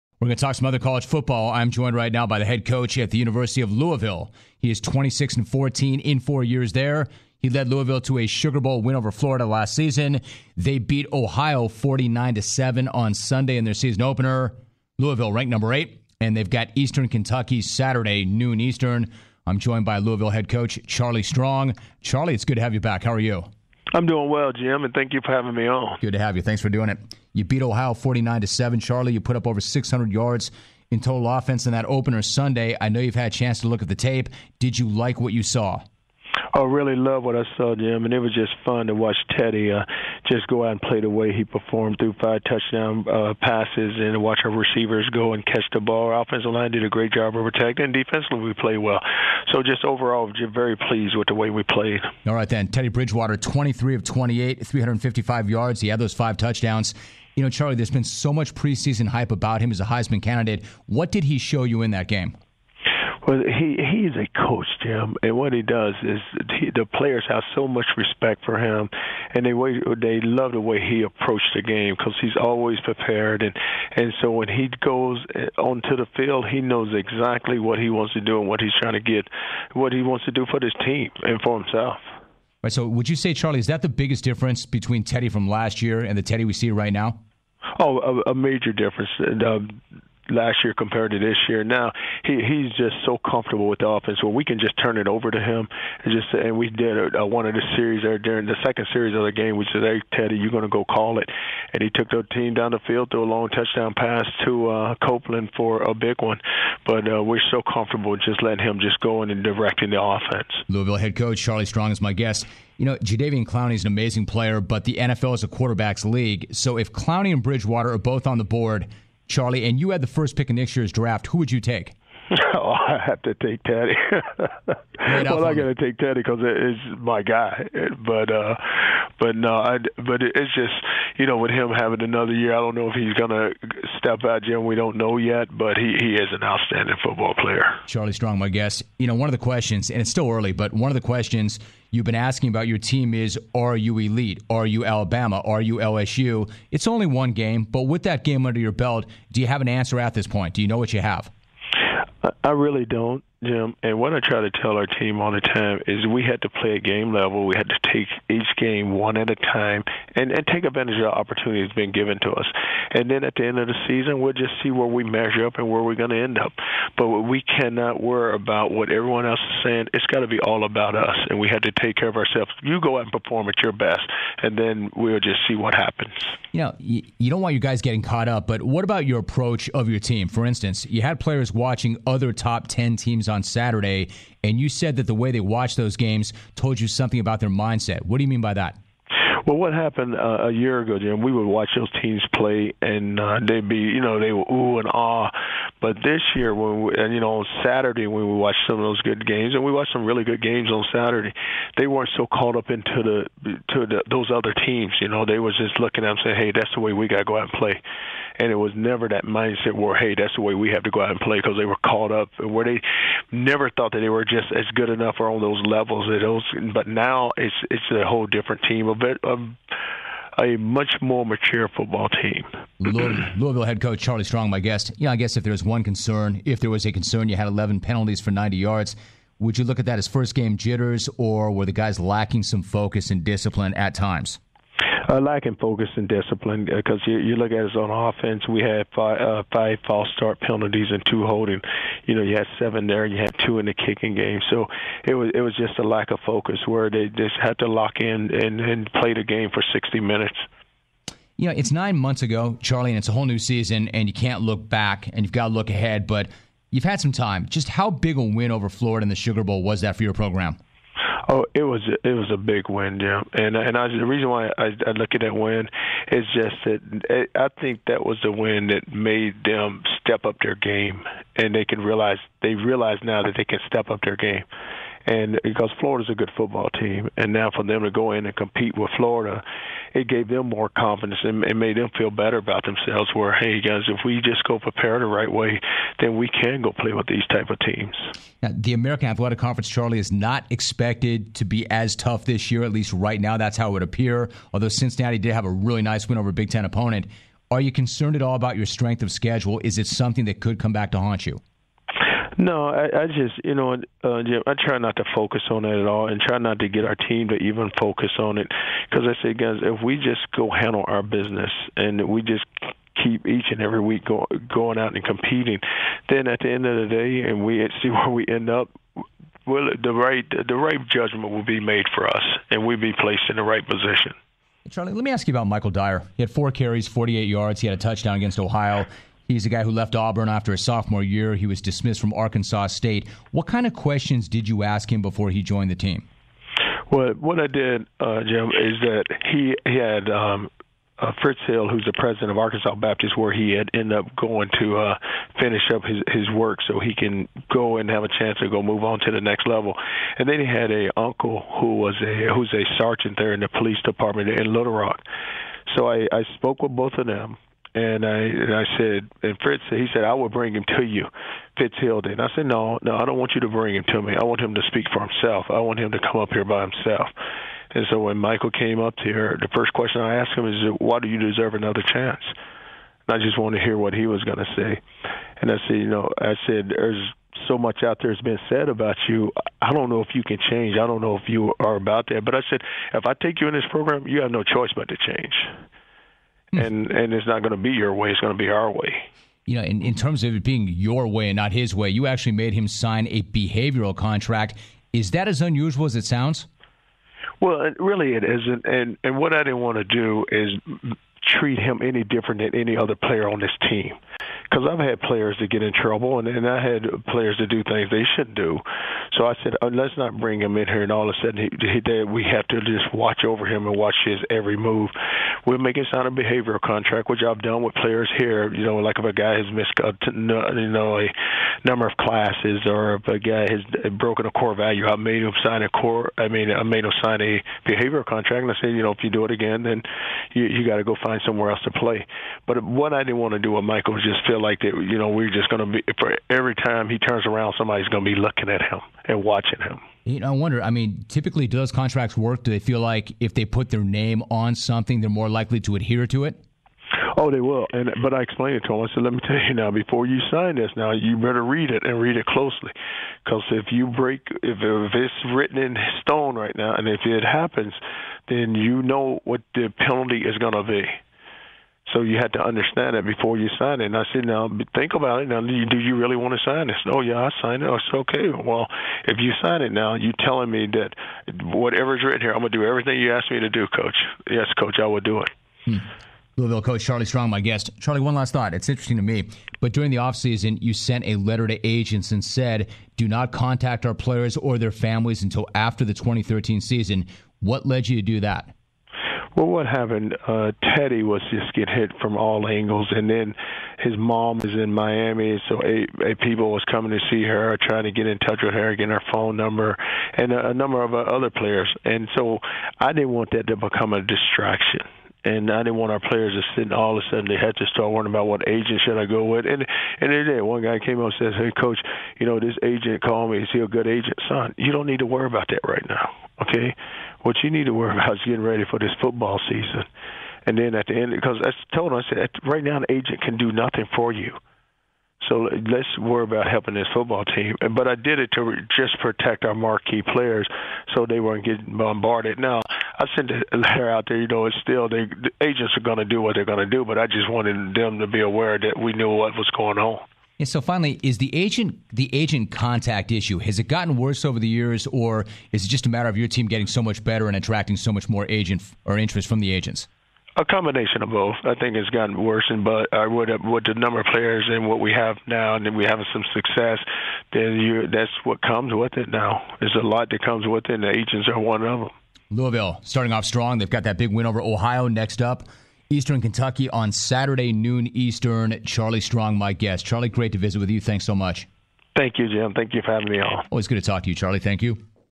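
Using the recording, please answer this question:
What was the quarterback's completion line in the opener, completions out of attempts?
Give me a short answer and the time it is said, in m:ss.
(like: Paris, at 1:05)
23 of 28, at 0:53.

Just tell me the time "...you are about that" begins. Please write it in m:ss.
6:21.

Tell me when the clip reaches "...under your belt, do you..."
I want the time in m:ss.
2:28.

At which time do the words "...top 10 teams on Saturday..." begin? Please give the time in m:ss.
3:02.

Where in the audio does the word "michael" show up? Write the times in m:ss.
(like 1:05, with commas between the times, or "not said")
5:25, 6:08, 7:13.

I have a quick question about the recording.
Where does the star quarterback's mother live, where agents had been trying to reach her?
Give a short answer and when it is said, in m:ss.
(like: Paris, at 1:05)
Miami, at 8:14.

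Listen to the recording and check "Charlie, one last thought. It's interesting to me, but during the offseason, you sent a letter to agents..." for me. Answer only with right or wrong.
right.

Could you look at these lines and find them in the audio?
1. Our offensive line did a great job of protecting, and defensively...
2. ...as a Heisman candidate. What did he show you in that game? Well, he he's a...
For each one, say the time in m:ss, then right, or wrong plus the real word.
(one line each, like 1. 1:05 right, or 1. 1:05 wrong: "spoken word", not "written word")
1. 0:46 right
2. 0:59 right.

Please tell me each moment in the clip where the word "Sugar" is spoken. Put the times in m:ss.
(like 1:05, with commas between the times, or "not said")
0:08, 4:19.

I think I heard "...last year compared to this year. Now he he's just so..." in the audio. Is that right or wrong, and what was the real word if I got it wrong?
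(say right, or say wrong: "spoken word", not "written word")
right.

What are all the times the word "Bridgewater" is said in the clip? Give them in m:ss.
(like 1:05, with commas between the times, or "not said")
0:52, 1:57.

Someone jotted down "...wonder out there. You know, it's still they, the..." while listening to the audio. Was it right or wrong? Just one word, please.
wrong.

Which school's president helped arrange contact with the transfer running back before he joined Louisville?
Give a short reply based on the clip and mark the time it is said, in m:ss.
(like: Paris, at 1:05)
Arkansas Baptist, at 5:42.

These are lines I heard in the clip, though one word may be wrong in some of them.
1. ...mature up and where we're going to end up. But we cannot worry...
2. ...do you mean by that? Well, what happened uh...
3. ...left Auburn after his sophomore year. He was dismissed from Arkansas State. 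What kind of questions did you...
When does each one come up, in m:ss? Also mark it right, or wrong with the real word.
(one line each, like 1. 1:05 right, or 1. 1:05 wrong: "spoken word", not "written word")
1. 2:45 wrong: "measure", not "mature"
2. 3:08 right
3. 5:29 right.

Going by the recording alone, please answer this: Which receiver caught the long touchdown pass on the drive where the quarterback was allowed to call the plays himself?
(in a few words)
Copeland.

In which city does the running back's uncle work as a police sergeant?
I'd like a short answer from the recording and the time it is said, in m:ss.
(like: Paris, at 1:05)
Little Rock, at 5:54.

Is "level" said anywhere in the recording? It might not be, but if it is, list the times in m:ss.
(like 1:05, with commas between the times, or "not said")
2:37, 3:35, 5:49.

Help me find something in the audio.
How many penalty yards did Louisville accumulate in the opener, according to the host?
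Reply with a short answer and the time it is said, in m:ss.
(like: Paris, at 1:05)
90, at 3:48.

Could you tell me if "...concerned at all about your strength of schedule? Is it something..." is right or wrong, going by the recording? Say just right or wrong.
right.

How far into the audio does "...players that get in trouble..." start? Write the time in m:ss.
6:44.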